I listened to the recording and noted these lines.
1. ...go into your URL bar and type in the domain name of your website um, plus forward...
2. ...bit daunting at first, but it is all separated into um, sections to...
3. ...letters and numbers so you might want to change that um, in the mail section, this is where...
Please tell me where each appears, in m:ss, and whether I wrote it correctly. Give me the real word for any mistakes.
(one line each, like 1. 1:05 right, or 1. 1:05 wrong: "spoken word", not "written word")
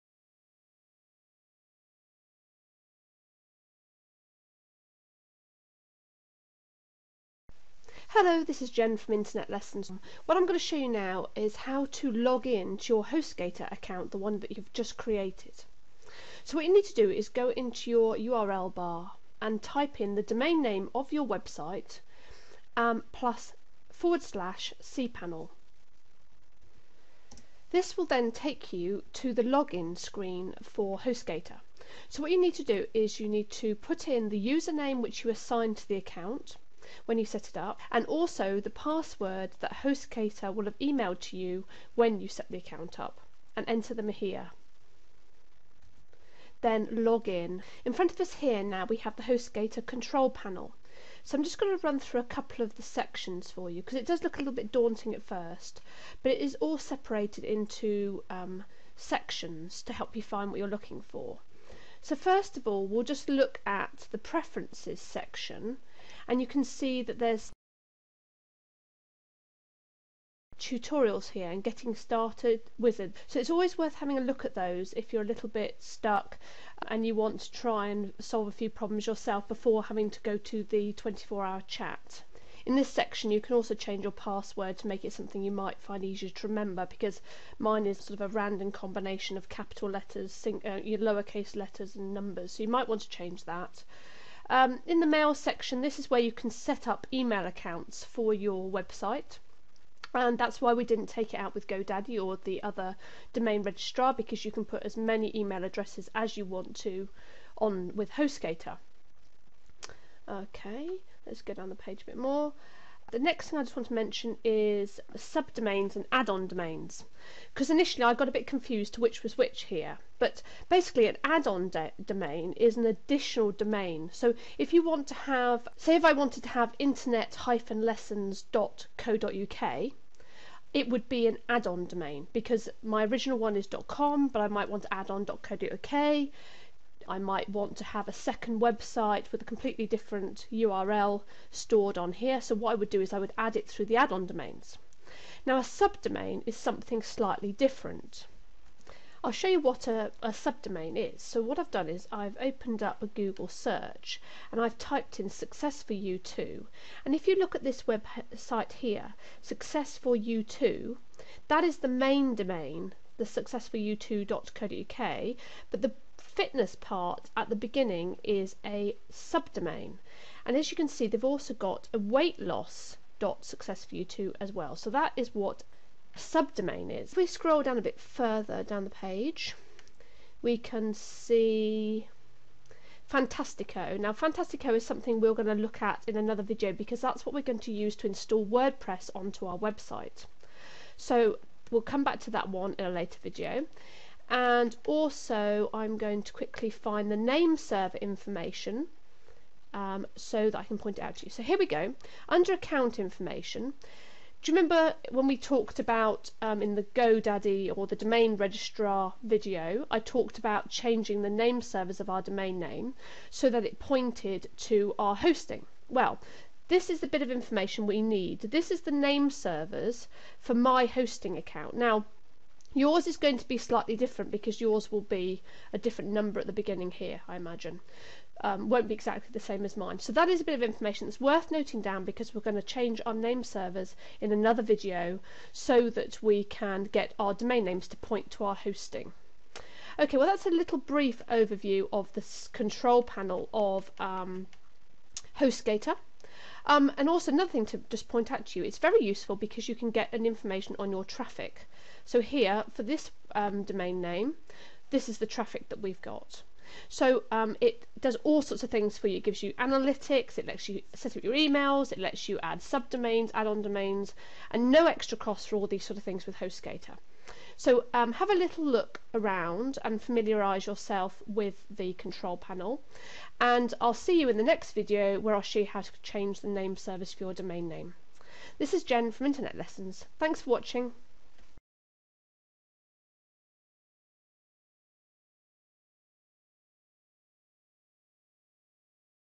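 1. 0:17 right
2. 0:54 right
3. 1:31 right.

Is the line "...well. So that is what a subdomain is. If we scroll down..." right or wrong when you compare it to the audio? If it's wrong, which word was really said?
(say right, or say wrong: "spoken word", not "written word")
right.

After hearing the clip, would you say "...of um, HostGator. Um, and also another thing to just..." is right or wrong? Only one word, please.
right.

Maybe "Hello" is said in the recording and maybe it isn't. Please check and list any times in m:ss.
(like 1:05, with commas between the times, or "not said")
0:08.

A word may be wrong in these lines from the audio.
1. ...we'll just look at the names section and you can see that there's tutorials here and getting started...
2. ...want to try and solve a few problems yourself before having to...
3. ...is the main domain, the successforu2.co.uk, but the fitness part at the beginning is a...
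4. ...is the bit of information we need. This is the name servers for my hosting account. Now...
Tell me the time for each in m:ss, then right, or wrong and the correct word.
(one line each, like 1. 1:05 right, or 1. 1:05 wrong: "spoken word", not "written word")
1. 1:02 wrong: "preferences", not "names"
2. 1:17 right
3. 2:41 right
4. 3:36 right.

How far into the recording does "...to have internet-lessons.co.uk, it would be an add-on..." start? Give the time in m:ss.
2:06.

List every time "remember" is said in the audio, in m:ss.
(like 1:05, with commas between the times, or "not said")
1:26, 3:24.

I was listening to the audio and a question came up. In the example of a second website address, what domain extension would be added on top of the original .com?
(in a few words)
.co.uk.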